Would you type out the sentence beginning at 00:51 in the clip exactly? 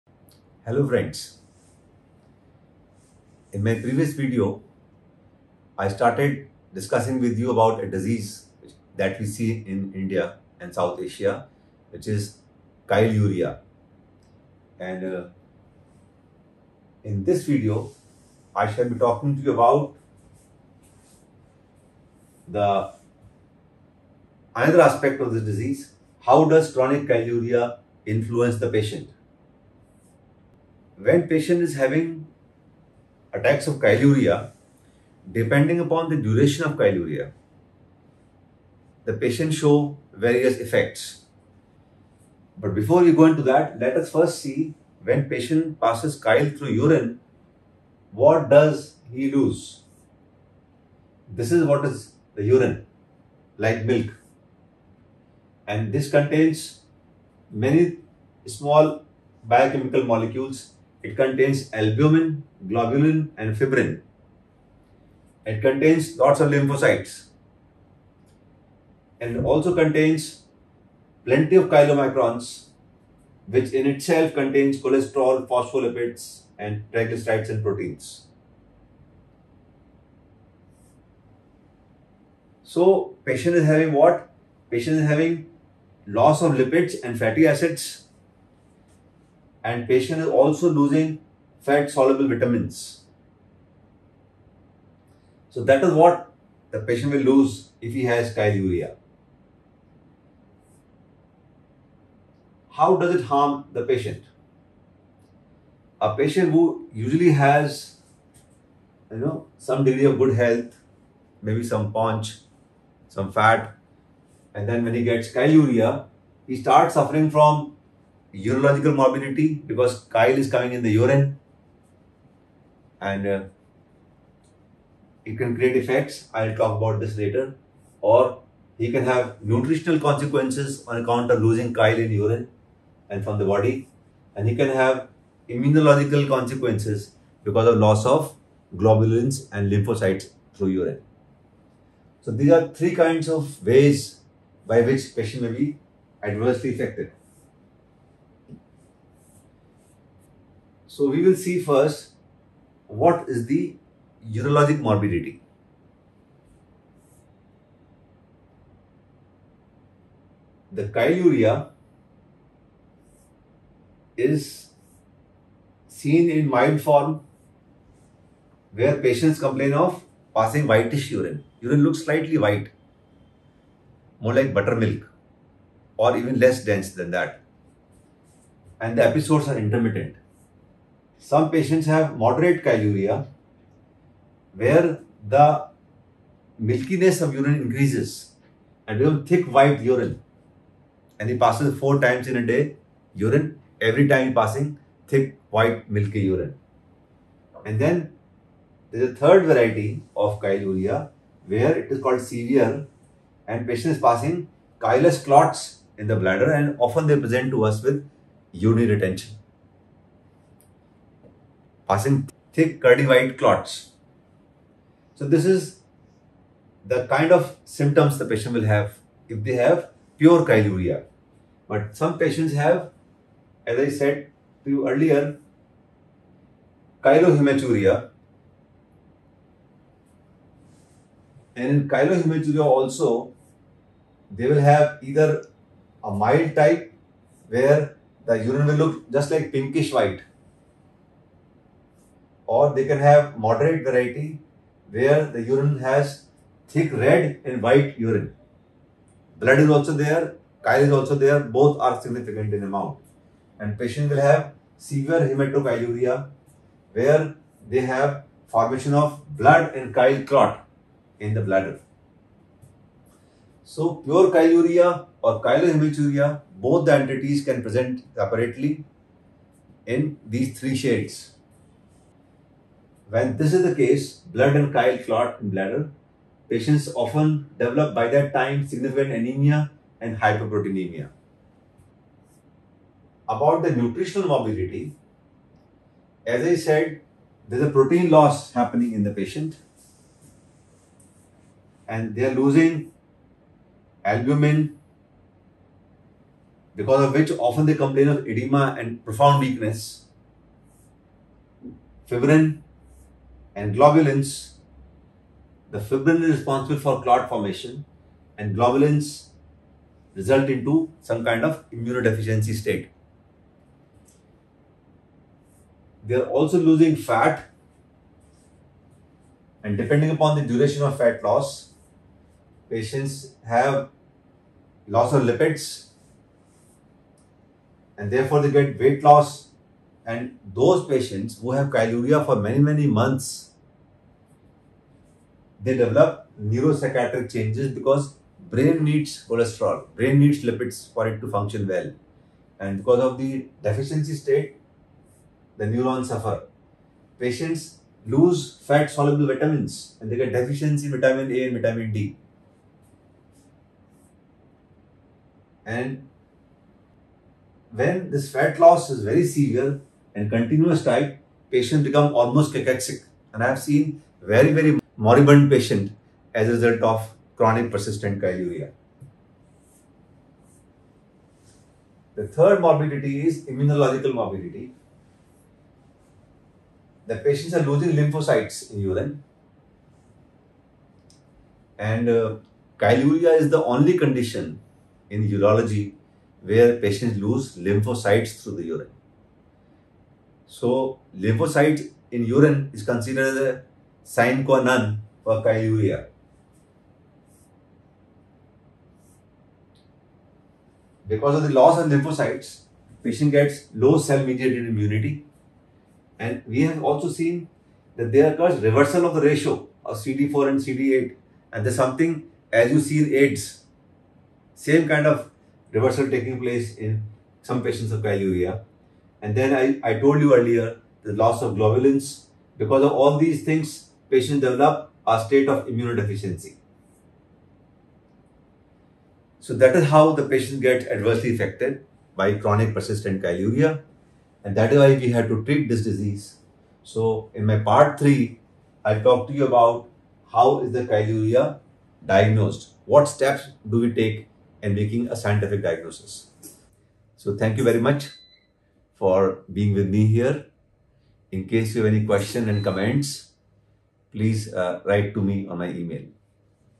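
This is what is the urine, like milk.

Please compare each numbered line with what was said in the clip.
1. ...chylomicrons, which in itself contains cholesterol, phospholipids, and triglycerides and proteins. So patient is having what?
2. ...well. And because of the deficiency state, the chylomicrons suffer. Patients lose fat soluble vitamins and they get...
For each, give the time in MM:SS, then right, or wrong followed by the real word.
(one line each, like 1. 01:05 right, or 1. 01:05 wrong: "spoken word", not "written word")
1. 01:11 right
2. 05:41 wrong: "neurons", not "chylomicrons".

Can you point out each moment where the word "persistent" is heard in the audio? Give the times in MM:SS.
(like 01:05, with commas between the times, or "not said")
06:07, 07:12.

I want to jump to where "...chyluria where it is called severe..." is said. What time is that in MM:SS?
03:20.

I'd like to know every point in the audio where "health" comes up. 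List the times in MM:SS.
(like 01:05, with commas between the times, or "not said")
01:50.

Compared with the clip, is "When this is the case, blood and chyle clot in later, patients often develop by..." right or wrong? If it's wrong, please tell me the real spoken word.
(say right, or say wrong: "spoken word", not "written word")
wrong: "bladder", not "later".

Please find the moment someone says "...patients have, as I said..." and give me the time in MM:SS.
03:42.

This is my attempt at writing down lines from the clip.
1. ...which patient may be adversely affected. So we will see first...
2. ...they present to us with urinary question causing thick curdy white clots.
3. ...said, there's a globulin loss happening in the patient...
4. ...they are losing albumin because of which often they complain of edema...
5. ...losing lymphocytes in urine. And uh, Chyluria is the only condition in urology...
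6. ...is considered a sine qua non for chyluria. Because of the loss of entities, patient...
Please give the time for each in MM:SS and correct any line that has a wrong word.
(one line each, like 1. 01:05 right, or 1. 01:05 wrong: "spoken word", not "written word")
1. 02:24 right
2. 03:27 wrong: "retention", not "question"
3. 04:46 wrong: "protein", not "globulin"
4. 04:52 right
5. 06:17 right
6. 06:32 wrong: "lymphocytes", not "entities".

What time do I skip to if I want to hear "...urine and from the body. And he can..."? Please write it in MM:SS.
02:12.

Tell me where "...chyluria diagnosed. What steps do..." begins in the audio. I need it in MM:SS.
07:20.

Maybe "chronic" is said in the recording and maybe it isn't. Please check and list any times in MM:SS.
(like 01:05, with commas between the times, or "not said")
00:26, 06:07, 07:12.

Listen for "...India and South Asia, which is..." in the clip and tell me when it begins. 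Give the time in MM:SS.
00:10.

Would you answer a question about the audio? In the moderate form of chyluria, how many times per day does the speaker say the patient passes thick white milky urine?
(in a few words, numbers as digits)
4.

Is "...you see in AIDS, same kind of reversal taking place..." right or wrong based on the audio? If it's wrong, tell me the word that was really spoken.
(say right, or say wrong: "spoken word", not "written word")
right.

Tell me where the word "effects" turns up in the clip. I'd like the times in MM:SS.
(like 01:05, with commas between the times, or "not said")
00:40, 02:05.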